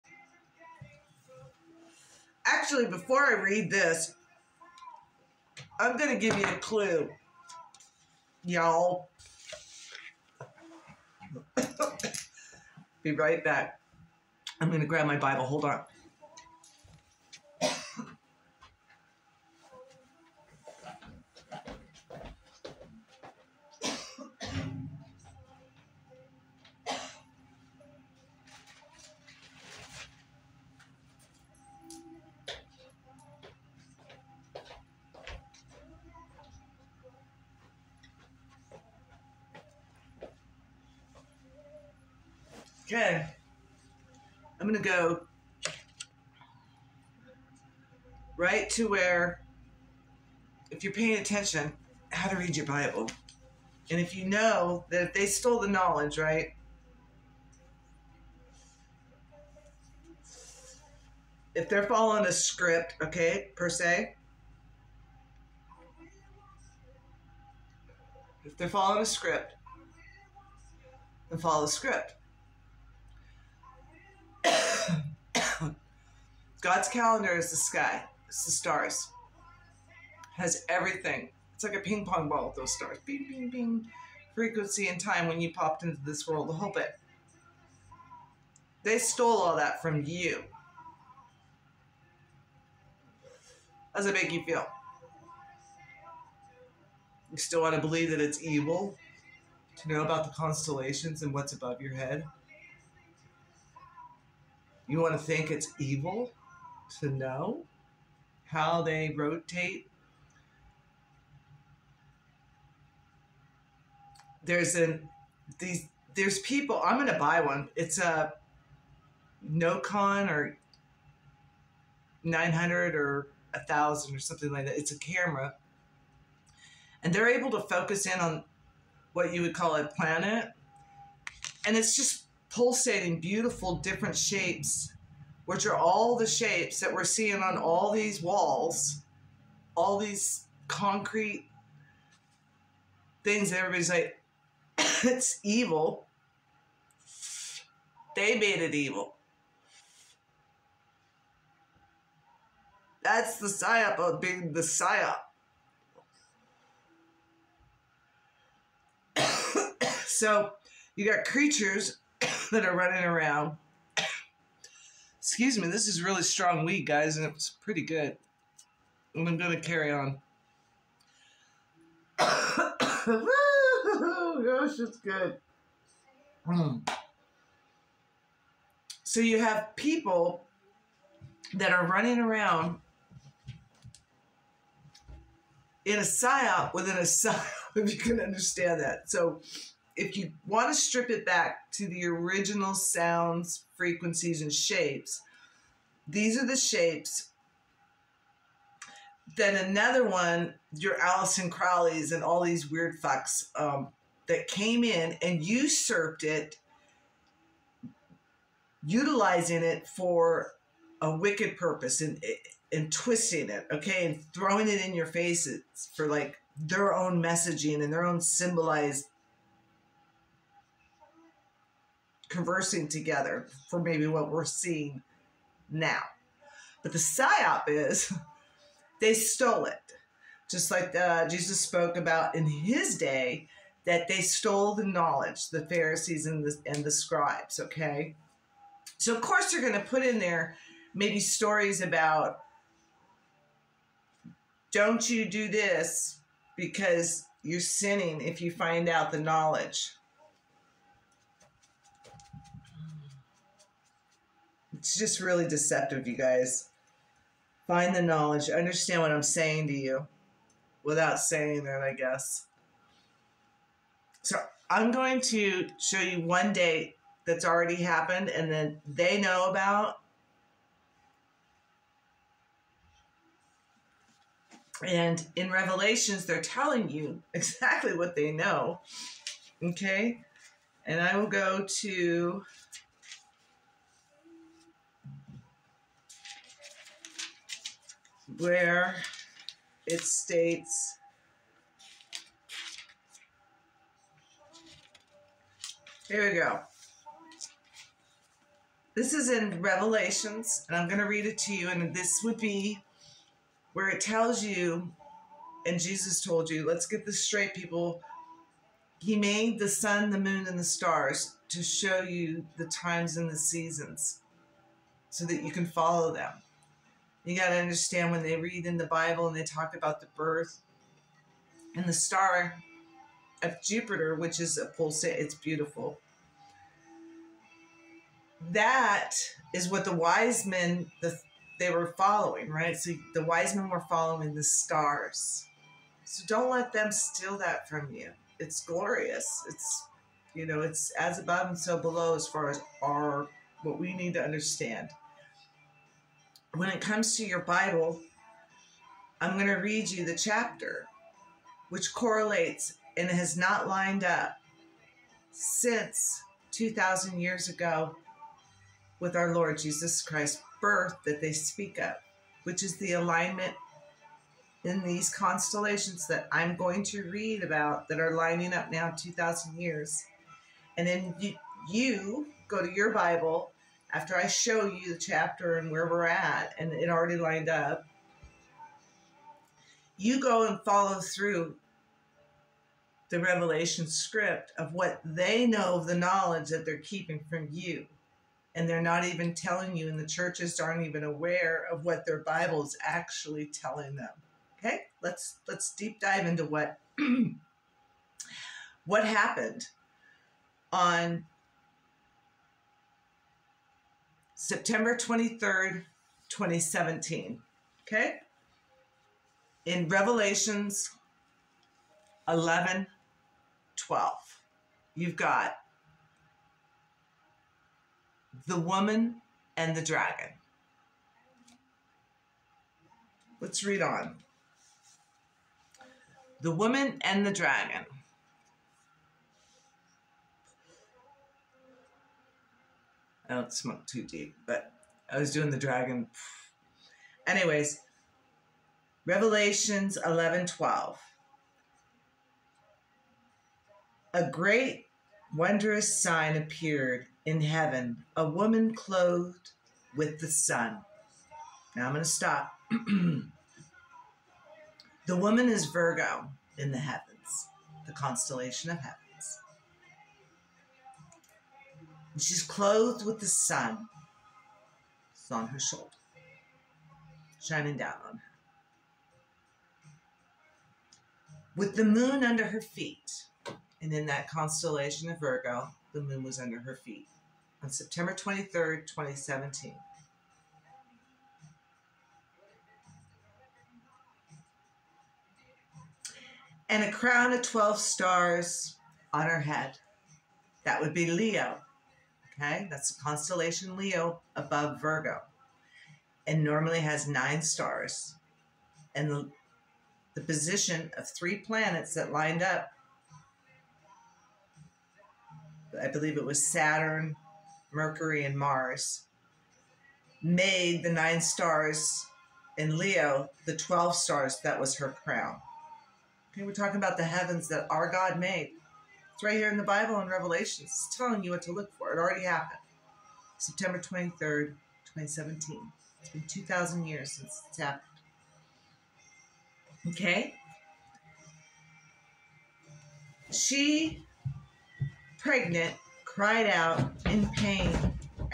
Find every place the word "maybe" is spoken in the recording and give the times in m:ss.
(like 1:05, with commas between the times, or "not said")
3:43, 4:00.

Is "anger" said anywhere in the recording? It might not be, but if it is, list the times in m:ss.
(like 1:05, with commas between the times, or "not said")
not said.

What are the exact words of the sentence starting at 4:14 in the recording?
it's just really deceptive, you guys.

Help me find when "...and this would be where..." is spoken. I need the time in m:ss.
5:01.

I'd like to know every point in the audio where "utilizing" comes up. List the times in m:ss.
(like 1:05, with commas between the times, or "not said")
3:28.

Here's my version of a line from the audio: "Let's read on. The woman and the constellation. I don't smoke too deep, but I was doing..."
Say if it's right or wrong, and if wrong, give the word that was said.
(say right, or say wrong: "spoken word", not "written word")
wrong: "dragon", not "constellation".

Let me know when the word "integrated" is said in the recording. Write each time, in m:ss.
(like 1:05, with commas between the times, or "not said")
not said.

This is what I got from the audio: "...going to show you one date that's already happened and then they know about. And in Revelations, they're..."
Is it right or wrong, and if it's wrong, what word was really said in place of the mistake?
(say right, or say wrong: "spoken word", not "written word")
right.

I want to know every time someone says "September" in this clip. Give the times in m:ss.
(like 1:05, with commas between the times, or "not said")
6:44, 7:57, 8:43.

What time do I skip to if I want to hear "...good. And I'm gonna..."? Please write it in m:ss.
2:47.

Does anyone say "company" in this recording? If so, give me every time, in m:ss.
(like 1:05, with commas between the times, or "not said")
not said.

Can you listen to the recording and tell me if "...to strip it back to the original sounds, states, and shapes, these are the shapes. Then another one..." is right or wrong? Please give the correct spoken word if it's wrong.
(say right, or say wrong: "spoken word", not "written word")
wrong: "frequencies", not "states".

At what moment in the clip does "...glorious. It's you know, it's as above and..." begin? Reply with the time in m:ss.
5:38.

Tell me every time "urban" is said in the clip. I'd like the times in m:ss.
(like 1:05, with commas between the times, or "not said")
not said.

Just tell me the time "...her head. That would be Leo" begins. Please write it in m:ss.
8:09.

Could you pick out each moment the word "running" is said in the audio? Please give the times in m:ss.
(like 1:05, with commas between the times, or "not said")
2:42, 3:01.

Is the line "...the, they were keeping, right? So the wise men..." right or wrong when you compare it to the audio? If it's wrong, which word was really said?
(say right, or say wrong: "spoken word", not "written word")
wrong: "following", not "keeping".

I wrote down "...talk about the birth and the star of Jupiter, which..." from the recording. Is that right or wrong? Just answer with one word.
right.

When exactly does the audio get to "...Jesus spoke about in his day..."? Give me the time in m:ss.
3:51.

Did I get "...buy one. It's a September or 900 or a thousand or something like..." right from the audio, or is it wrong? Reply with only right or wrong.
wrong.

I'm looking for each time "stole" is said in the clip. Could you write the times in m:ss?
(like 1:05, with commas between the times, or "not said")
0:55, 1:28, 3:49, 3:54.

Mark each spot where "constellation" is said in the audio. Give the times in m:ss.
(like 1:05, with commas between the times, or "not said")
1:40, 6:05, 7:37, 7:54, 8:13.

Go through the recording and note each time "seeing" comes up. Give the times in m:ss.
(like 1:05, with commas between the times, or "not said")
2:17, 3:44.